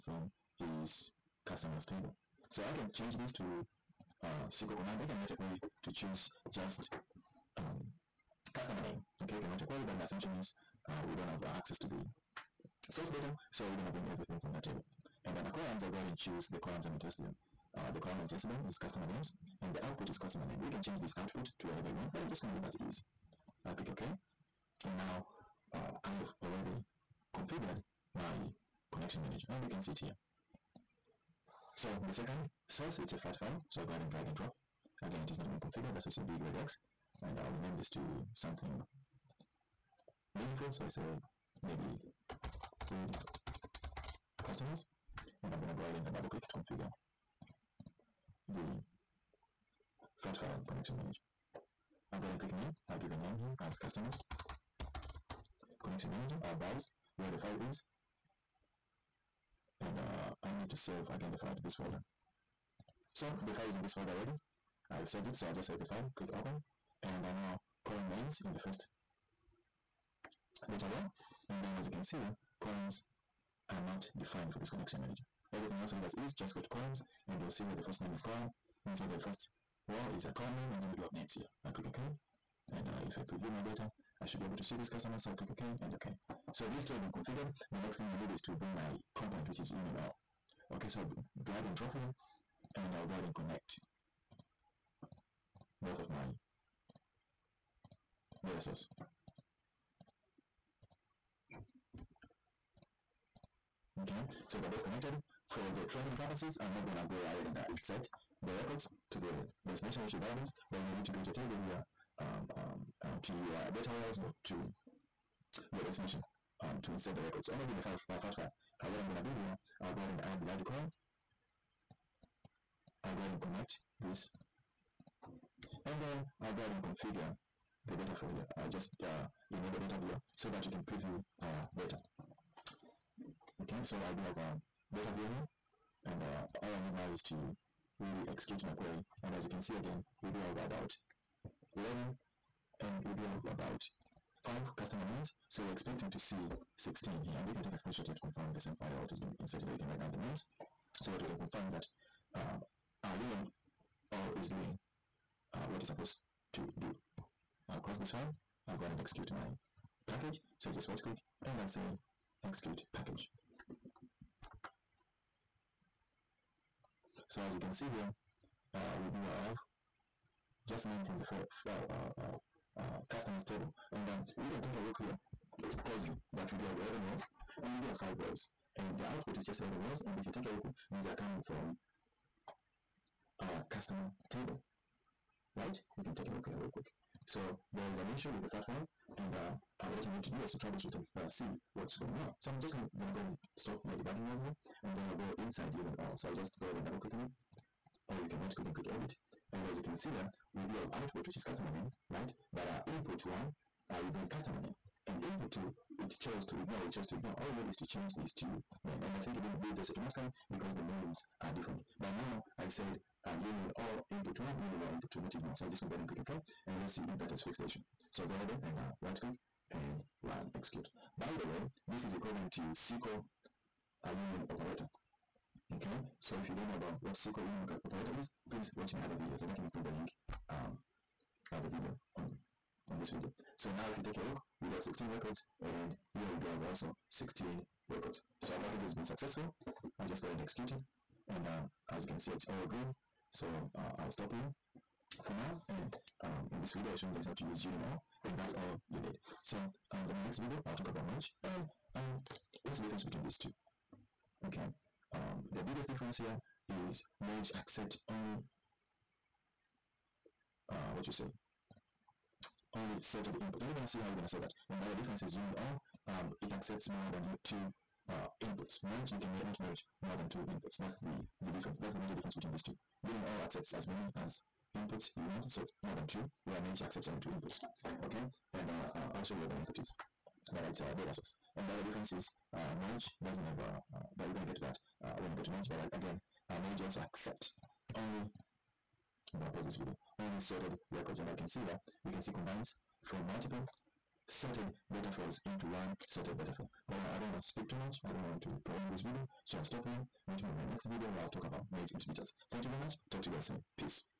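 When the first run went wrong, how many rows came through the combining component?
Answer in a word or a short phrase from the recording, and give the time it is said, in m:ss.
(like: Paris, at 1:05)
11, at 2:59.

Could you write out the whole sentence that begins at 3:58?
So our package has been successful.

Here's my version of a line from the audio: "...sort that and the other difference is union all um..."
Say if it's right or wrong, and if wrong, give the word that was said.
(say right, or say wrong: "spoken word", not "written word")
right.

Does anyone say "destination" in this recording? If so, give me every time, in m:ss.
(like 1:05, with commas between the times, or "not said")
1:49, 1:55.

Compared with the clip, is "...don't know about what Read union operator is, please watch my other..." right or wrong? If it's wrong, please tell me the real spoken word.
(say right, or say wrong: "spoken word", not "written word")
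wrong: "SQL", not "Read".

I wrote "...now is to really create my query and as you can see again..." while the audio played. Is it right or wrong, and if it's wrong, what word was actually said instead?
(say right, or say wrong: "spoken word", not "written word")
wrong: "execute", not "create".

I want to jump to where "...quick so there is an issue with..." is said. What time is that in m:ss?
3:06.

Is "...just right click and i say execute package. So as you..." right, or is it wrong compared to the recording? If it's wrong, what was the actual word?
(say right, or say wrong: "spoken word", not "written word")
right.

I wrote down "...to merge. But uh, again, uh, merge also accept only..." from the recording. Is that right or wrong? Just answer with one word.
right.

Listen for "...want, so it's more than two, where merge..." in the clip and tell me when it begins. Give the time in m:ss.
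4:35.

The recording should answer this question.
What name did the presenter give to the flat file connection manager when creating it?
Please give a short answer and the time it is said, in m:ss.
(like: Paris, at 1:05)
customers connection manager, at 0:53.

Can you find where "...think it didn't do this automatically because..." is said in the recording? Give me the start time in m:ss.
3:29.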